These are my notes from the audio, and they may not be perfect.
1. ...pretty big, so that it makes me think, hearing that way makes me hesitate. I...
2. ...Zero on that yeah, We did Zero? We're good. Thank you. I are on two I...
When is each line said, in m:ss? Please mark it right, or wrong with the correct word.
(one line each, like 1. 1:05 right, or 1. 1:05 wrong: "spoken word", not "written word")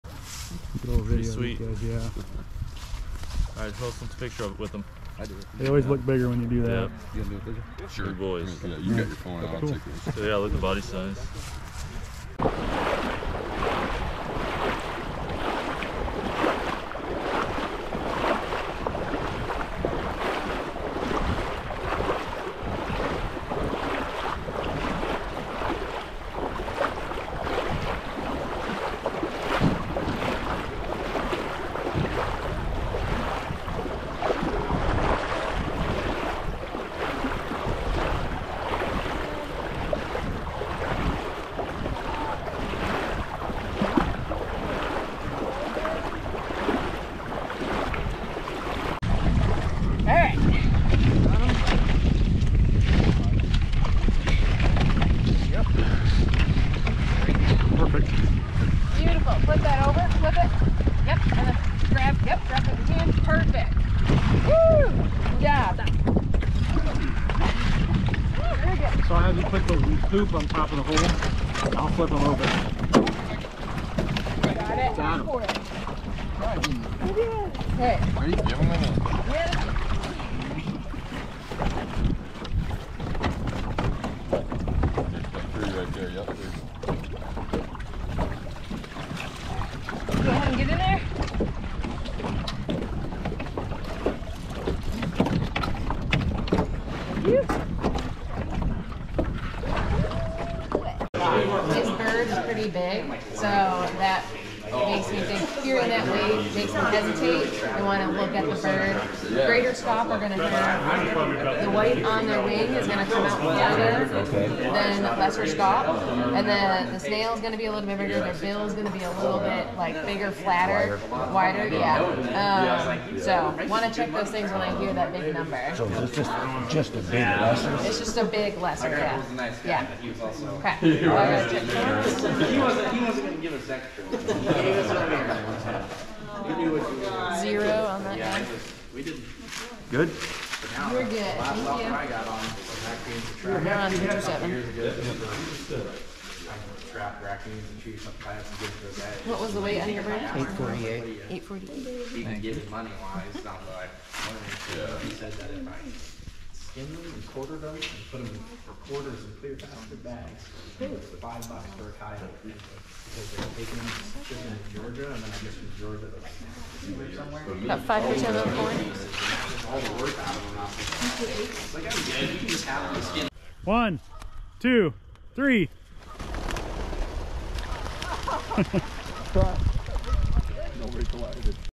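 1. 1:42 right
2. 2:17 wrong: "Good", not "Zero".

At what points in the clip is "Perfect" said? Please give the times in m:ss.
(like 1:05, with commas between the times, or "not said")
0:57, 1:03.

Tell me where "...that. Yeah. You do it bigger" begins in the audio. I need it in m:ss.
0:06.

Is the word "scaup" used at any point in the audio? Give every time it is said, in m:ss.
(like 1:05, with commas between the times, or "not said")
1:49, 1:55.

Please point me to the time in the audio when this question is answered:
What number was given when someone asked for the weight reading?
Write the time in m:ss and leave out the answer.
2:30.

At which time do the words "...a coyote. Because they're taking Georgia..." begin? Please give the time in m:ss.
2:41.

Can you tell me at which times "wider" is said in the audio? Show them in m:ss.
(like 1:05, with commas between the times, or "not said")
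1:53, 2:01.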